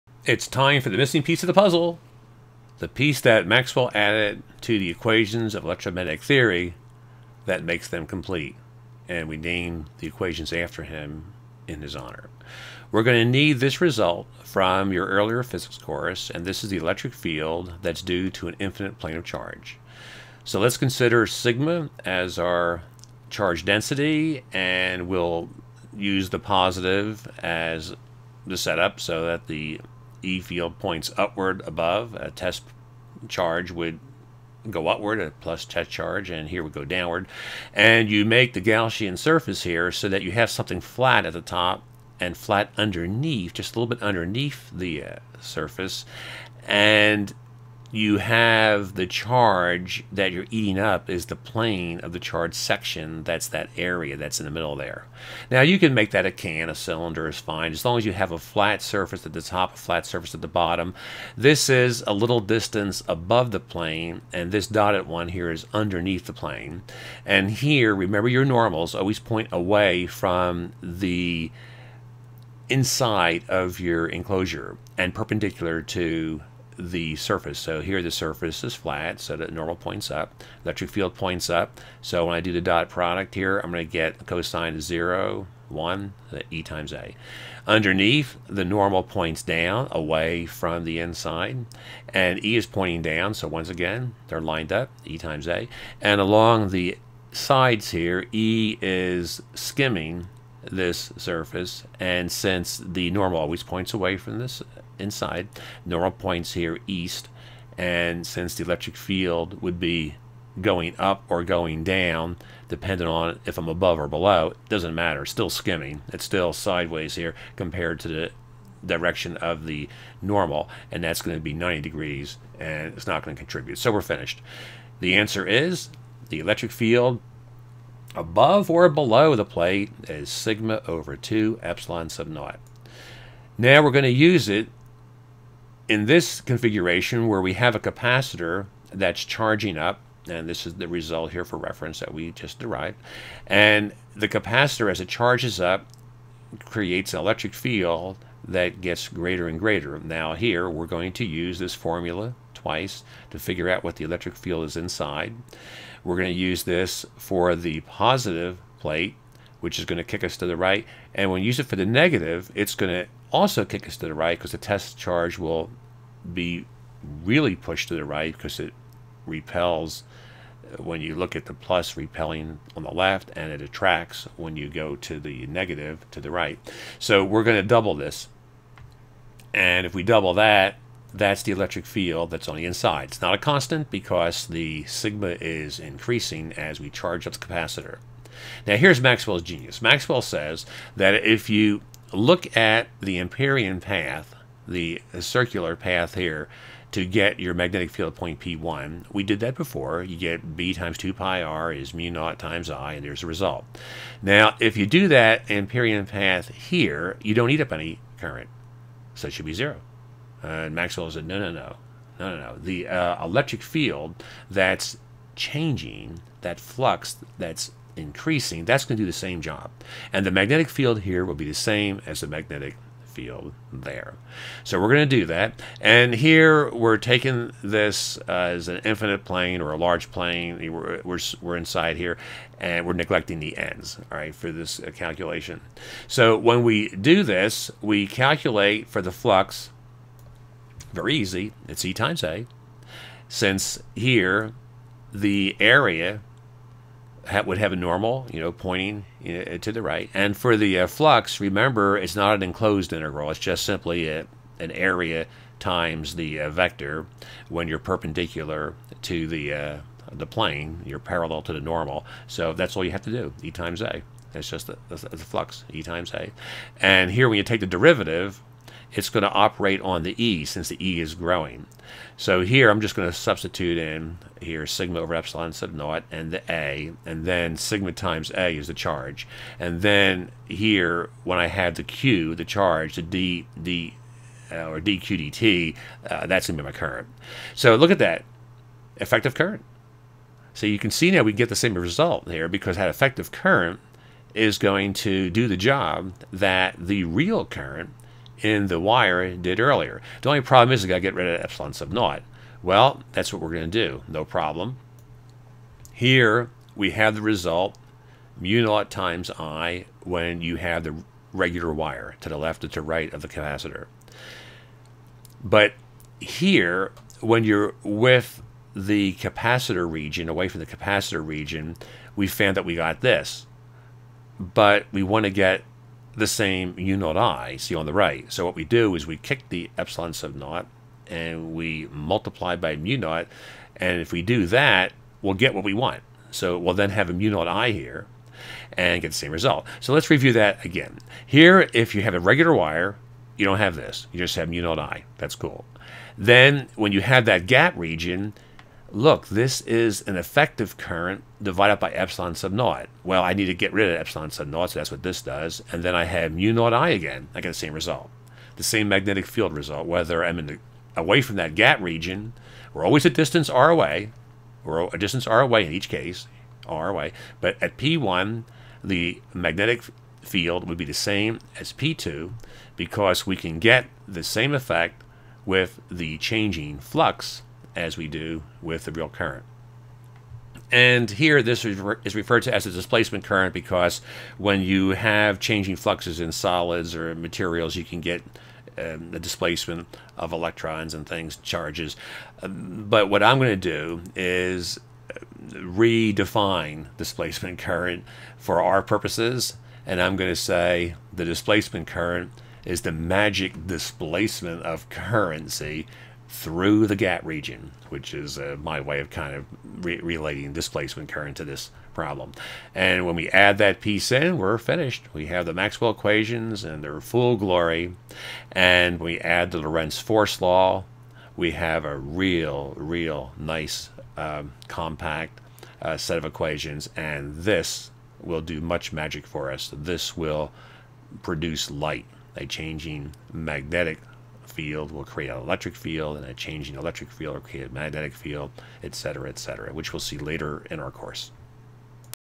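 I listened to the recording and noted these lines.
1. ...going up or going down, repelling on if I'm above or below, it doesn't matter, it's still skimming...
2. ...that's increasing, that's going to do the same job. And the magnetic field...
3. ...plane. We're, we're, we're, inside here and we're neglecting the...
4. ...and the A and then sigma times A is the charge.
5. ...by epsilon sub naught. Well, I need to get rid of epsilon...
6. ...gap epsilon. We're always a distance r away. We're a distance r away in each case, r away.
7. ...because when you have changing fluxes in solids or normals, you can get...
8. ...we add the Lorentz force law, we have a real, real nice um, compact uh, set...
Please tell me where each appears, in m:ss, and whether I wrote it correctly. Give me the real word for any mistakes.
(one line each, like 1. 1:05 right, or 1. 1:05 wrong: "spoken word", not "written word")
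1. 1:50 wrong: "depending", not "repelling"
2. 3:37 right
3. 3:50 right
4. 4:36 right
5. 5:51 right
6. 6:01 wrong: "region", not "epsilon"
7. 6:23 wrong: "materials", not "normals"
8. 6:59 right.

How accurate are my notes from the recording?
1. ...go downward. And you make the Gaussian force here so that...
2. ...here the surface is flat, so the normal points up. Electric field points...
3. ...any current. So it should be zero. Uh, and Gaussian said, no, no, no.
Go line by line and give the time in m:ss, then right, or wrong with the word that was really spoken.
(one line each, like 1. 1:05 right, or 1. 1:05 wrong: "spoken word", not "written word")
1. 0:36 wrong: "surface", not "force"
2. 1:17 right
3. 3:27 wrong: "Maxwell", not "Gaussian".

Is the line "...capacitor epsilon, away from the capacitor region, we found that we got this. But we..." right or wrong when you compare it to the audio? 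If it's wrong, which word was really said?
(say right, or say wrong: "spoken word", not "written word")
wrong: "region", not "epsilon".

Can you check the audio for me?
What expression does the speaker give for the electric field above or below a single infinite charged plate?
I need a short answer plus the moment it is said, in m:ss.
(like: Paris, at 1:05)
sigma over 2 epsilon naught, at 2:10.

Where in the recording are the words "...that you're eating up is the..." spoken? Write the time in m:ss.
0:50.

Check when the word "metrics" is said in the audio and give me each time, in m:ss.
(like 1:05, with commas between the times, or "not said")
not said.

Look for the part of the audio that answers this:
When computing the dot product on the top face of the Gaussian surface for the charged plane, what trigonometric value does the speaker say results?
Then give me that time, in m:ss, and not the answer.
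1:24.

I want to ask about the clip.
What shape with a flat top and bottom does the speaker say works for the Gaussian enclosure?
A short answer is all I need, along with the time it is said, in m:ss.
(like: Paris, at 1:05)
a cylinder, at 0:56.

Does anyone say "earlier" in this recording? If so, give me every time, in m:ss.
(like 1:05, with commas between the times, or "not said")
0:15, 4:59.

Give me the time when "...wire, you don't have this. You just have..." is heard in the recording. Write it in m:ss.
5:42.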